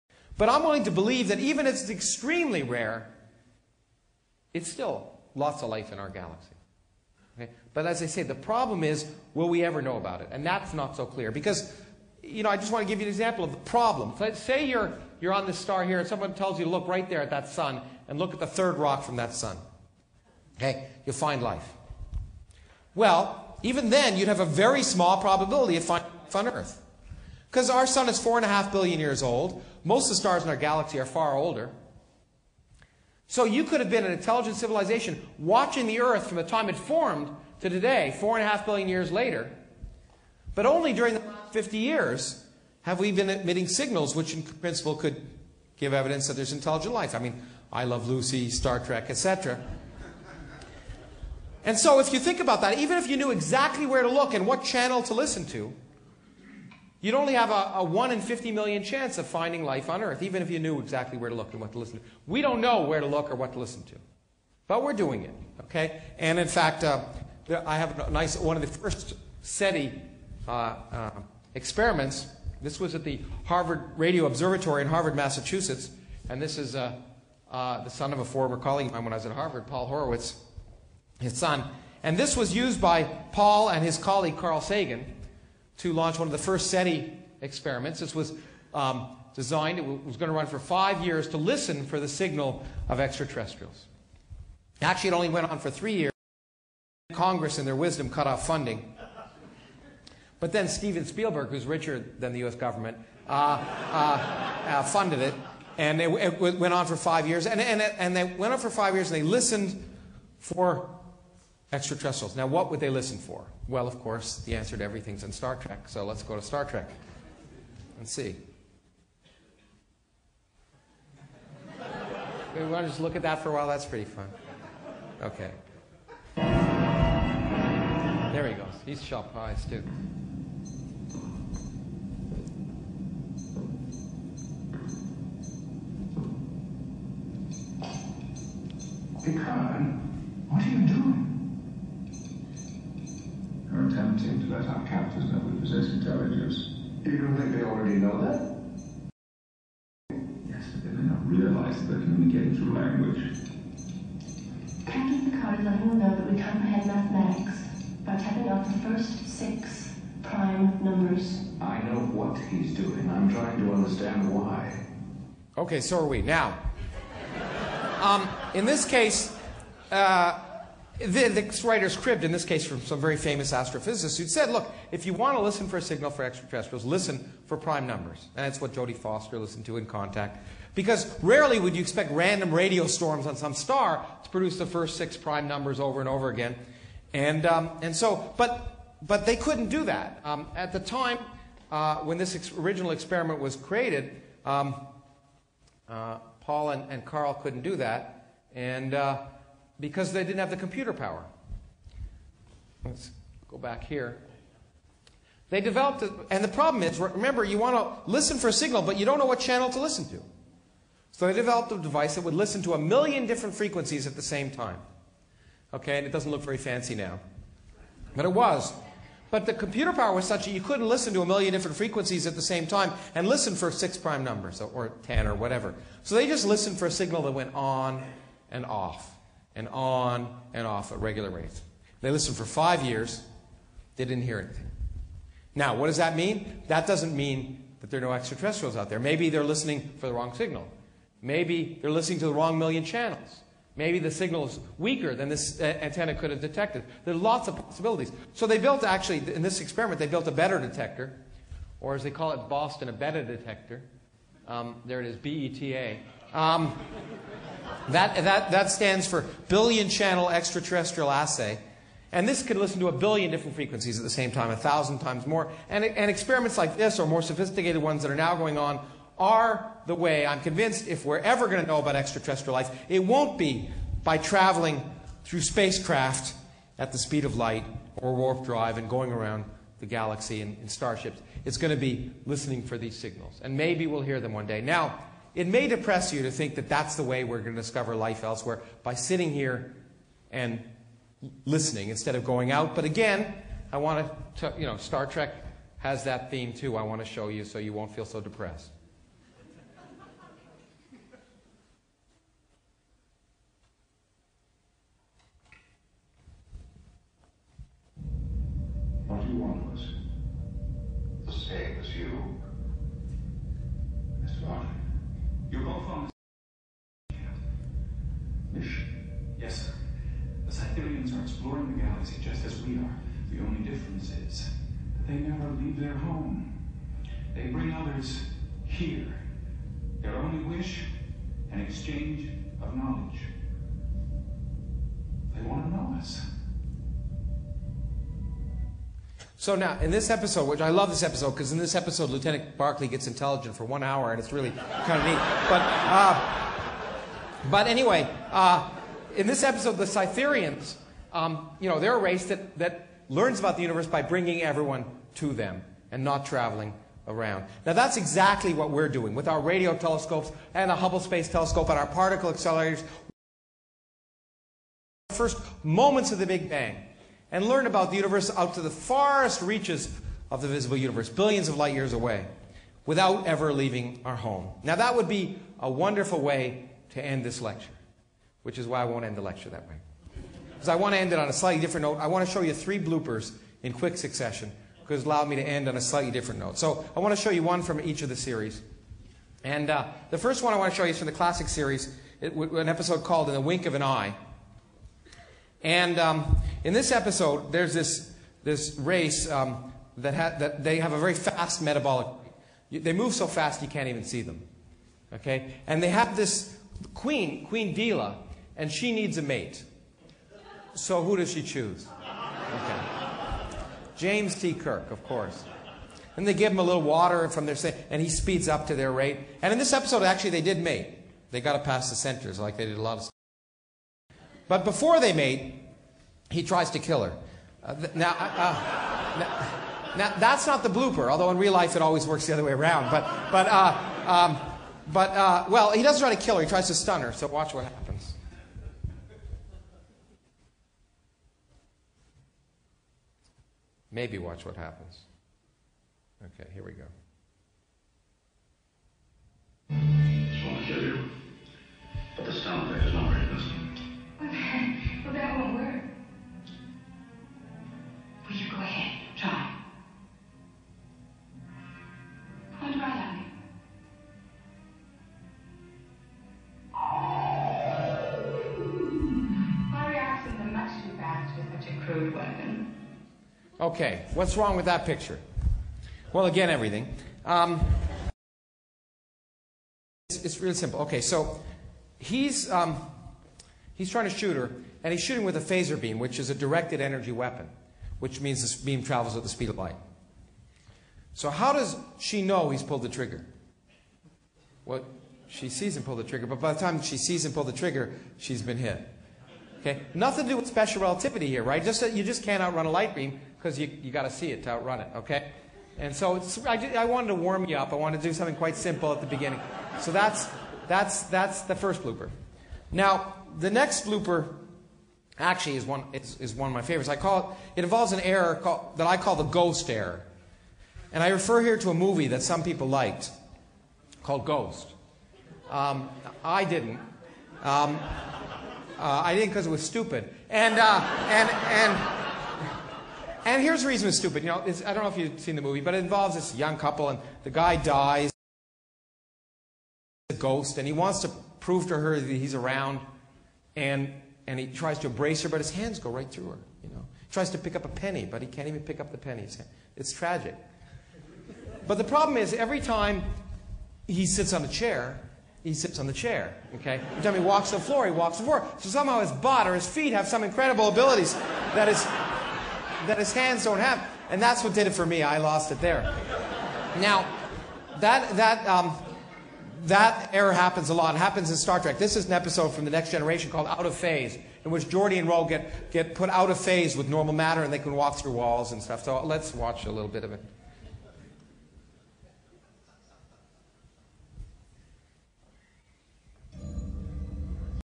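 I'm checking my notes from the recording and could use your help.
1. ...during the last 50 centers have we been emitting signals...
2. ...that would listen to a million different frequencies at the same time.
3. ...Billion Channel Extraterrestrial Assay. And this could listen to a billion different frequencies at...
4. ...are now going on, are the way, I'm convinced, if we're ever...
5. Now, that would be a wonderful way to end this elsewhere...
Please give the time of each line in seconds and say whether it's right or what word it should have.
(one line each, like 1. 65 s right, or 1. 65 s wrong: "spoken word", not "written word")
1. 40 s wrong: "years", not "centers"
2. 212 s right
3. 259 s right
4. 268 s right
5. 374 s wrong: "lecture", not "elsewhere".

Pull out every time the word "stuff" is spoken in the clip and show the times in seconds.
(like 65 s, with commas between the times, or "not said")
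423 s, 578 s.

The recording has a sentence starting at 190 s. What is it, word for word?
Um, at the time uh, when this ex original experiment was created, um, uh, Paul and, and Carl couldn't do that.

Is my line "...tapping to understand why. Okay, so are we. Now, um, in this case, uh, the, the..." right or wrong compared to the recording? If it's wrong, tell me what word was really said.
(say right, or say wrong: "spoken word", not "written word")
wrong: "trying", not "tapping".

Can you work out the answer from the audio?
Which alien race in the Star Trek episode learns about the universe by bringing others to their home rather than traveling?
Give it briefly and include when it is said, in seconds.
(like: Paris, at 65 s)
Cytherians, at 349 s.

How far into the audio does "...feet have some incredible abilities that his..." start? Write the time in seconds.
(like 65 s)
559 s.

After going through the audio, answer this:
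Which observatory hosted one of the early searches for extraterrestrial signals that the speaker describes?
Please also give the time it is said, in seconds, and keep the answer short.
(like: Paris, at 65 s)
Harvard Radio Observatory, at 73 s.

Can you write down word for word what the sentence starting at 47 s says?
I mean, I Love Lucy, Star Trek, etc.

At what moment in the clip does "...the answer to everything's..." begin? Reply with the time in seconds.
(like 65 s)
114 s.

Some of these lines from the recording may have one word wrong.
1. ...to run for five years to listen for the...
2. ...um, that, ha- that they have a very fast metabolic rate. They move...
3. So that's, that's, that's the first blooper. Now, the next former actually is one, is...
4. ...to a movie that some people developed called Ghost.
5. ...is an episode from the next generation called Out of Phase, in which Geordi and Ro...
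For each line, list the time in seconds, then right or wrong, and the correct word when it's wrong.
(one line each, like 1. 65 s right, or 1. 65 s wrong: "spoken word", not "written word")
1. 90 s right
2. 399 s right
3. 509 s wrong: "blooper", not "former"
4. 521 s wrong: "liked", not "developed"
5. 571 s right.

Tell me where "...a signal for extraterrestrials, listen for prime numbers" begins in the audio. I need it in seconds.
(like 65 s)
175 s.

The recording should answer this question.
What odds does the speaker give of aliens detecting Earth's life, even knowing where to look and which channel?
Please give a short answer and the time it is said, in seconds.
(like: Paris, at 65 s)
1 in 50 million, at 57 s.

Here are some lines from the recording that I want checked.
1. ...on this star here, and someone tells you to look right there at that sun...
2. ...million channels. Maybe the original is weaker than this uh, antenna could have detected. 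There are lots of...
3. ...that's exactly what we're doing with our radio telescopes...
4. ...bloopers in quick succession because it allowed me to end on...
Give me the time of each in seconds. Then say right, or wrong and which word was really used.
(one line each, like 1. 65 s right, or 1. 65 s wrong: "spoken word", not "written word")
1. 15 s right
2. 242 s wrong: "signal", not "original"
3. 357 s right
4. 382 s right.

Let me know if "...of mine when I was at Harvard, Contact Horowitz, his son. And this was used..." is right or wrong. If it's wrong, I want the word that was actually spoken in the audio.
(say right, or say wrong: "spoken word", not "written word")
wrong: "Paul", not "Contact".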